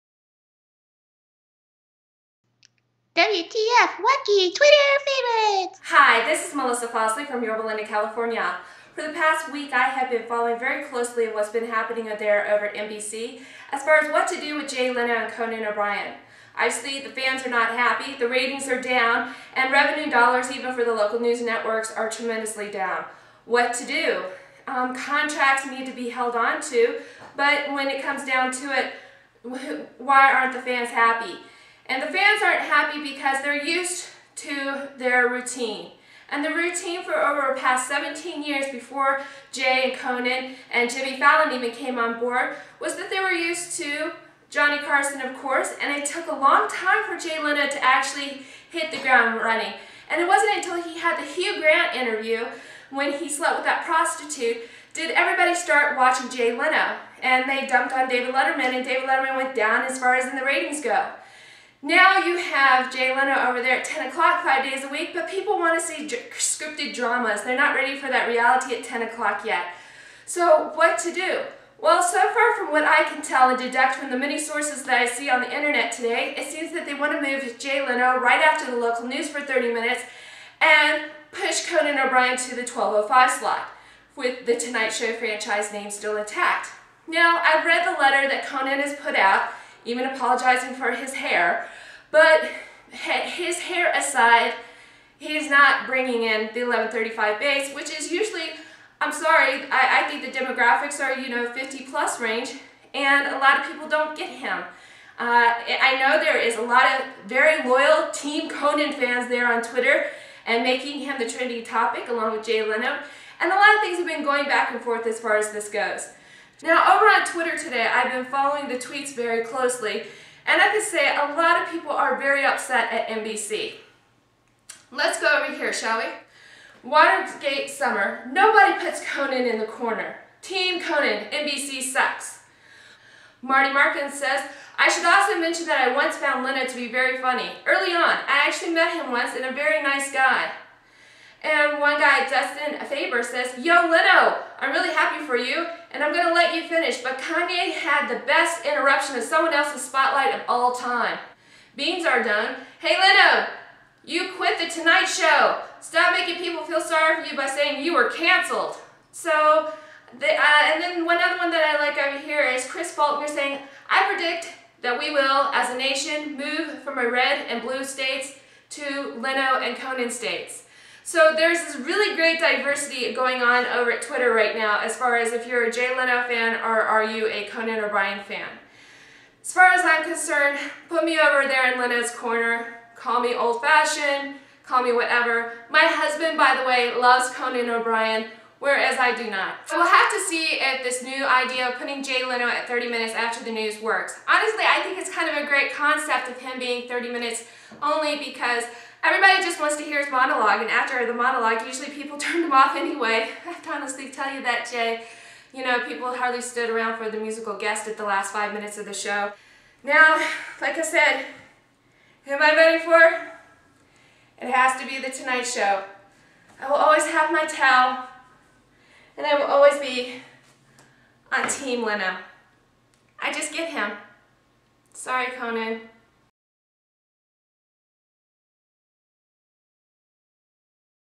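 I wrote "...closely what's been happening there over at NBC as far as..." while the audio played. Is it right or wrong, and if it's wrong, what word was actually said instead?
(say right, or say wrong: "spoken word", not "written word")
right.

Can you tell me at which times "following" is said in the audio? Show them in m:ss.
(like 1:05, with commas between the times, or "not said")
0:10, 1:58.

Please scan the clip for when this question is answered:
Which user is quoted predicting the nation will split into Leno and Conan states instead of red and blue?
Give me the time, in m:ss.
2:42.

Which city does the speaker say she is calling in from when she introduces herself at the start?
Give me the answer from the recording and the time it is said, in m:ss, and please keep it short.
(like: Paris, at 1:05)
Yorba Linda, at 0:07.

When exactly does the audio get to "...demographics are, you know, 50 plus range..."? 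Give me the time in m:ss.
1:40.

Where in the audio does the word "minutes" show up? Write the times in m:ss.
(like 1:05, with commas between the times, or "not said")
1:19, 3:12, 3:17, 3:28.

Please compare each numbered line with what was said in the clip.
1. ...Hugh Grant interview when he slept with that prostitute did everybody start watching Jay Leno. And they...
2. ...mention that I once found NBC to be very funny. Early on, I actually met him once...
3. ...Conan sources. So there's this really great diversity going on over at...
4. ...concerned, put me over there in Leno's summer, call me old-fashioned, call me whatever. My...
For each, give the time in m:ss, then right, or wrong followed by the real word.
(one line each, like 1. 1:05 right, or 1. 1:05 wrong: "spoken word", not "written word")
1. 0:51 right
2. 2:15 wrong: "Leno", not "NBC"
3. 2:49 wrong: "states", not "sources"
4. 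3:00 wrong: "corner", not "summer".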